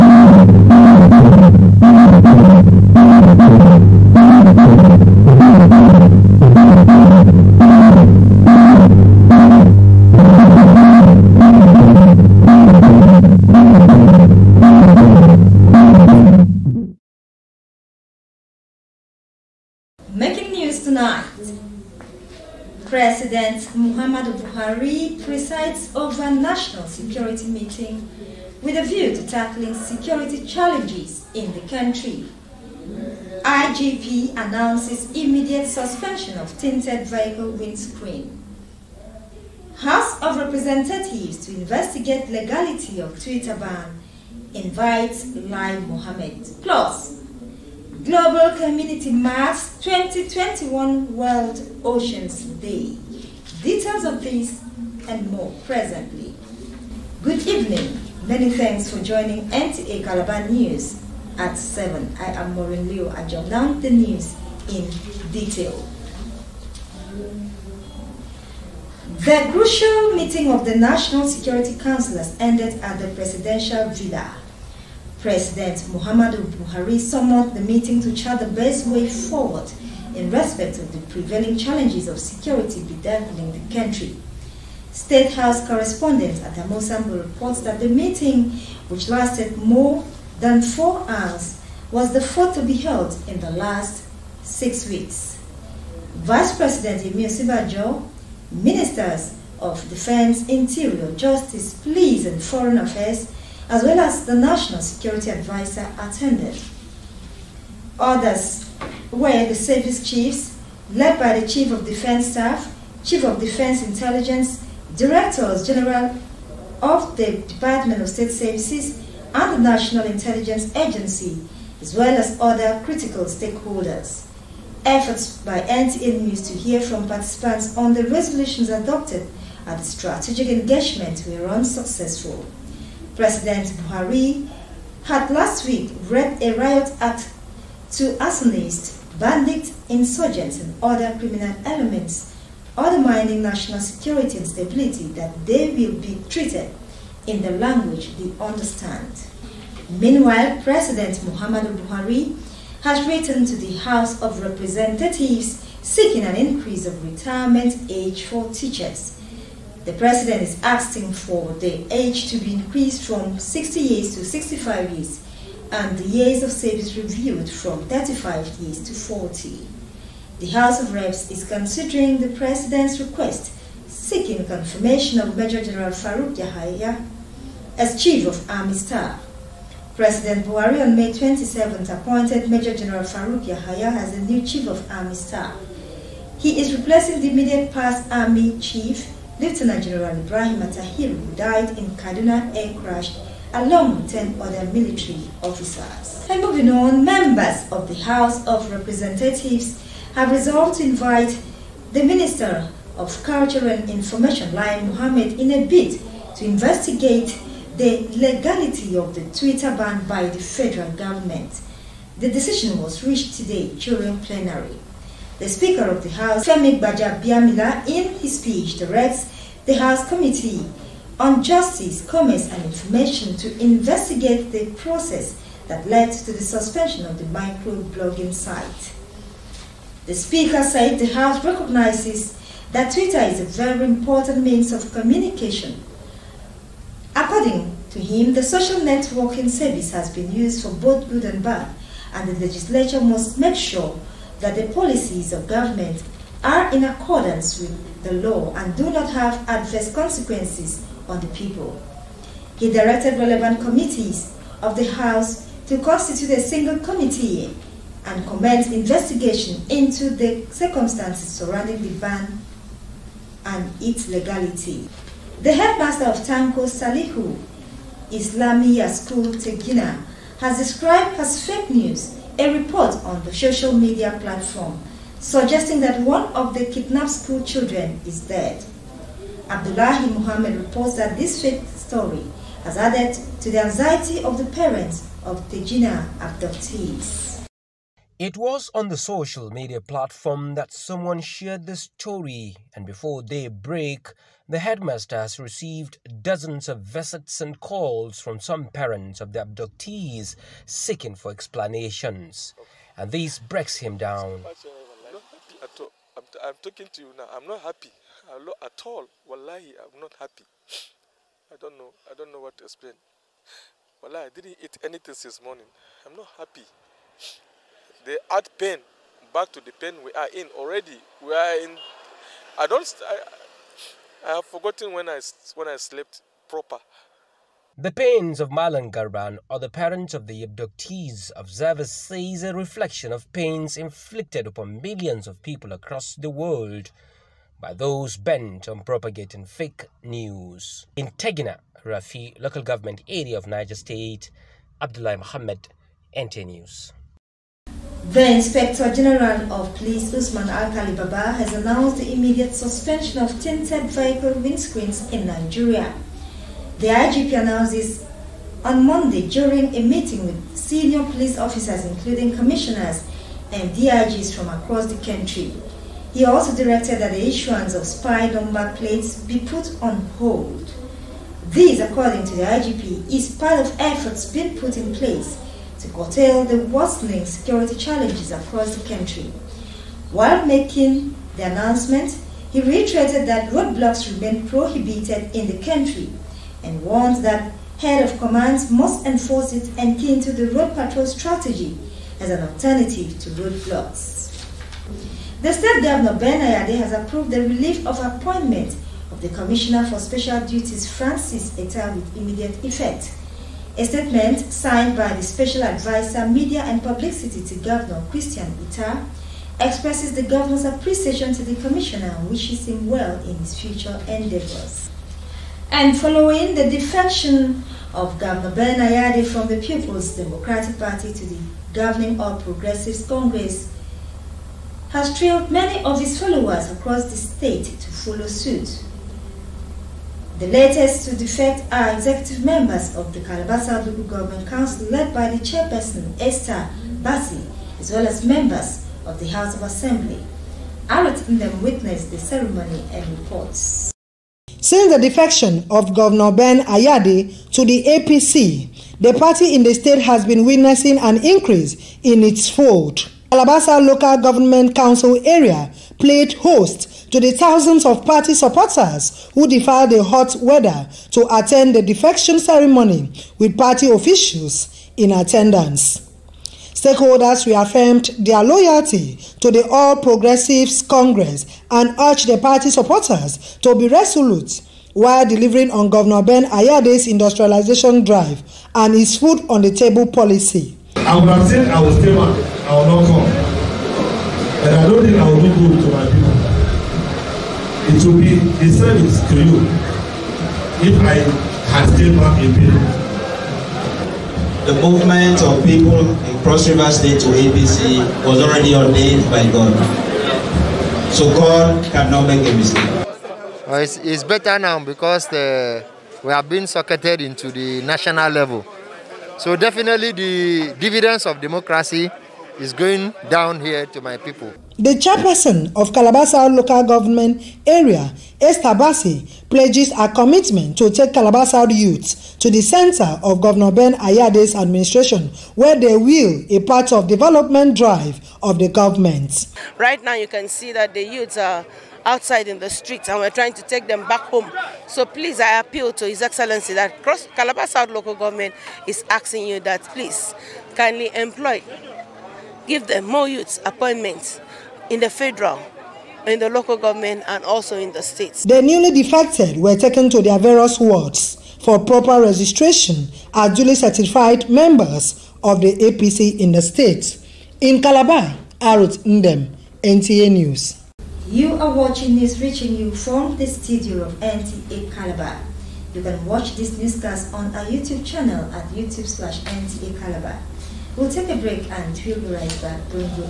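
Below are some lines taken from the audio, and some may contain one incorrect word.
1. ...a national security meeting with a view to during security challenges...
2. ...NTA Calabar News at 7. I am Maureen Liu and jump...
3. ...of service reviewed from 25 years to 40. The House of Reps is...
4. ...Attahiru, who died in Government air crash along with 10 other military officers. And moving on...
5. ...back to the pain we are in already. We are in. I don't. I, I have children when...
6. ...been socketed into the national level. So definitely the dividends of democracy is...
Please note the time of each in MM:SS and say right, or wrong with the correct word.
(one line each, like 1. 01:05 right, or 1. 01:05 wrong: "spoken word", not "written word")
1. 00:26 wrong: "tackling", not "during"
2. 00:59 right
3. 02:46 wrong: "35", not "25"
4. 03:10 wrong: "Kaduna", not "Government"
5. 05:19 wrong: "forgotten", not "children"
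6. 08:26 right.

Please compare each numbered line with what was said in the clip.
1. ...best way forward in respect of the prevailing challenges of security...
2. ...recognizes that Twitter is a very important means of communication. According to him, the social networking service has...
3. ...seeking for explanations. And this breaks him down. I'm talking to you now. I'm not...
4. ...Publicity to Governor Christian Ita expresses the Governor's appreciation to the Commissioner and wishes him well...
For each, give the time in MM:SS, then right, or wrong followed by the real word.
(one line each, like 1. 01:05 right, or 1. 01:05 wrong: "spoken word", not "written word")
1. 01:18 right
2. 03:51 right
3. 05:00 right
4. 06:46 right.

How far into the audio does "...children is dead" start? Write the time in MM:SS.
04:37.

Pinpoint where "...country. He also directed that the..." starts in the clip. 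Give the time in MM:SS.
06:05.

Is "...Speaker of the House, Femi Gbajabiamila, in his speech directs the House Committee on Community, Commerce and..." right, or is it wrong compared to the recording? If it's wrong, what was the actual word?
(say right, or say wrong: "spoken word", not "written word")
wrong: "Justice", not "Community".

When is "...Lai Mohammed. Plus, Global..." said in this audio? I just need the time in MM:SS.
00:45.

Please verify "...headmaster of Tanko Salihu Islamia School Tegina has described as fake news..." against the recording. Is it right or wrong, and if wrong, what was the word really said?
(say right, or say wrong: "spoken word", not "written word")
right.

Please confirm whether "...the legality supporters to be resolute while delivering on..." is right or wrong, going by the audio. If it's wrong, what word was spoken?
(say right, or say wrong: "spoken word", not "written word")
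wrong: "party", not "legality".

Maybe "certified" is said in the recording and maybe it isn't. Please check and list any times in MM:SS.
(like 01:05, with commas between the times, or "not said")
09:13.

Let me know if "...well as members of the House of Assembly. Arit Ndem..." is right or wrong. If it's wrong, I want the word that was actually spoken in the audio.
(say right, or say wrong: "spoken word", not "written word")
right.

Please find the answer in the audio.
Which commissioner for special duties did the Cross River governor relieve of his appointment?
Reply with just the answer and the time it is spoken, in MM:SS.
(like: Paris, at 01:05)
Francis Eta, at 06:40.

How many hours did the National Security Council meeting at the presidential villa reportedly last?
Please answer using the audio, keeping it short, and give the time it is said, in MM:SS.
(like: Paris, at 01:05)
more than 4 hours, at 01:29.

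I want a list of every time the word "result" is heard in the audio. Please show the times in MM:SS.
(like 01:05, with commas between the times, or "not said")
not said.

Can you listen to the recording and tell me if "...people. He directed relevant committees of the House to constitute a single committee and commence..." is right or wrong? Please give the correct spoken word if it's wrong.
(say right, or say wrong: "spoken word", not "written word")
right.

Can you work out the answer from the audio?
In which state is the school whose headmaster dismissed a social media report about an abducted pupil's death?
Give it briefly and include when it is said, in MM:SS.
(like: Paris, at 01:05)
Niger State, at 05:43.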